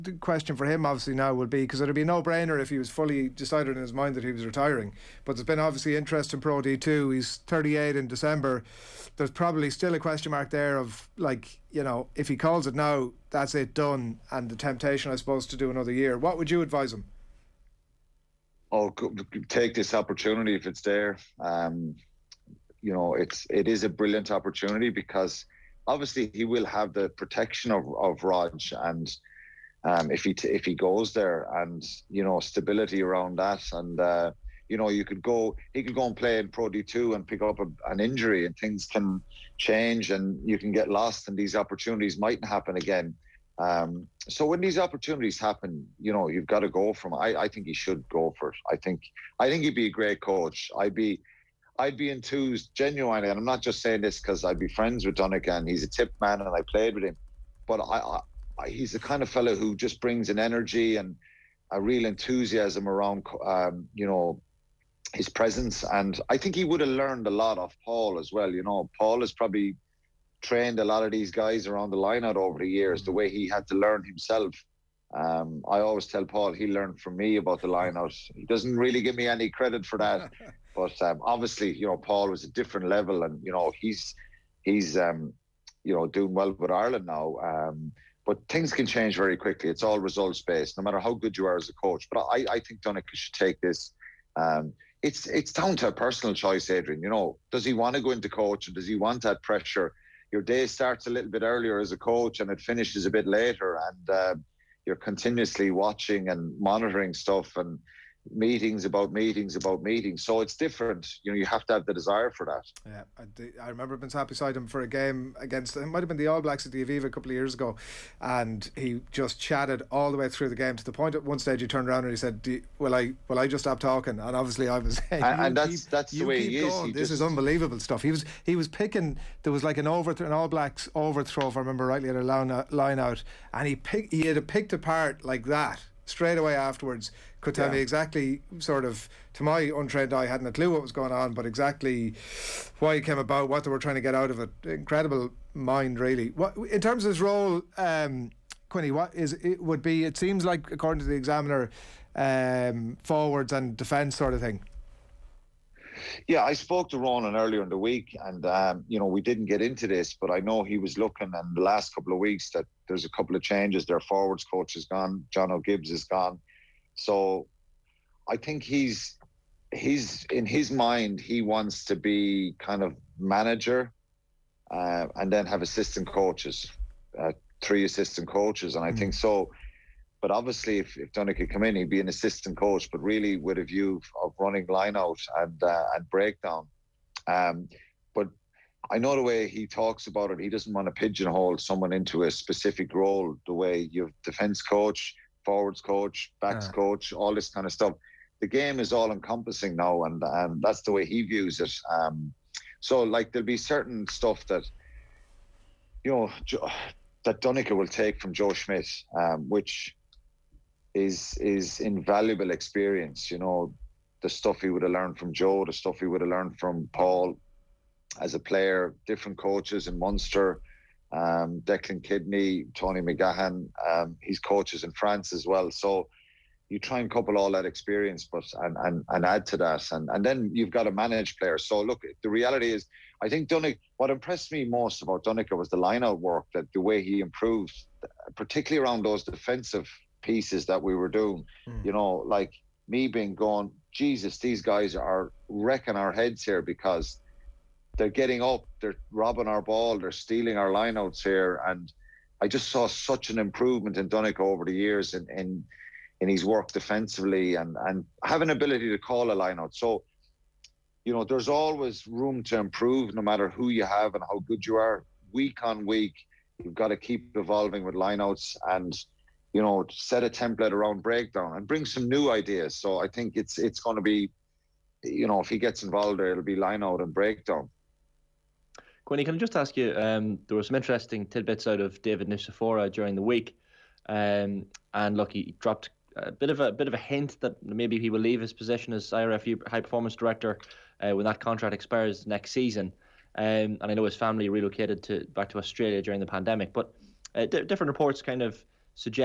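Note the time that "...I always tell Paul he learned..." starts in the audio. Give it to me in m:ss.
1:15.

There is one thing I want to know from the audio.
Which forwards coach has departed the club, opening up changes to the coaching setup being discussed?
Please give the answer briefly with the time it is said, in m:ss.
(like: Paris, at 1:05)
Jono Gibbes, at 2:45.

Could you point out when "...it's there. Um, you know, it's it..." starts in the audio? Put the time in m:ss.
0:20.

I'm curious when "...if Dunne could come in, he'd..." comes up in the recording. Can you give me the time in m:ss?
3:00.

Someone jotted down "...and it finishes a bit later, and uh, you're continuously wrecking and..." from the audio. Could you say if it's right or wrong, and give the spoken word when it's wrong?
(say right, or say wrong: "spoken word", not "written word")
wrong: "watching", not "wrecking".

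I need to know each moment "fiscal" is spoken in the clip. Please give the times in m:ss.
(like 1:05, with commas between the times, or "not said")
not said.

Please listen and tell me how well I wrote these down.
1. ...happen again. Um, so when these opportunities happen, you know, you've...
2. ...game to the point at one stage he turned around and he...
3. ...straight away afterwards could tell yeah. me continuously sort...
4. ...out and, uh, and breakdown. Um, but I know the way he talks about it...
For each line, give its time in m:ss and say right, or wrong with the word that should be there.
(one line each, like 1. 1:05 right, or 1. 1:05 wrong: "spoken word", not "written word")
1. 0:42 right
2. 2:00 right
3. 2:16 wrong: "exactly", not "continuously"
4. 3:04 right.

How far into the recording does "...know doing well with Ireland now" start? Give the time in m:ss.
1:25.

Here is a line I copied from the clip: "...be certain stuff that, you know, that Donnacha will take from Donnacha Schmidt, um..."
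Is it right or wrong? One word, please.
wrong.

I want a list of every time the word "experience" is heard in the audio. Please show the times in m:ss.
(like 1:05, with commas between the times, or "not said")
3:32, 3:47.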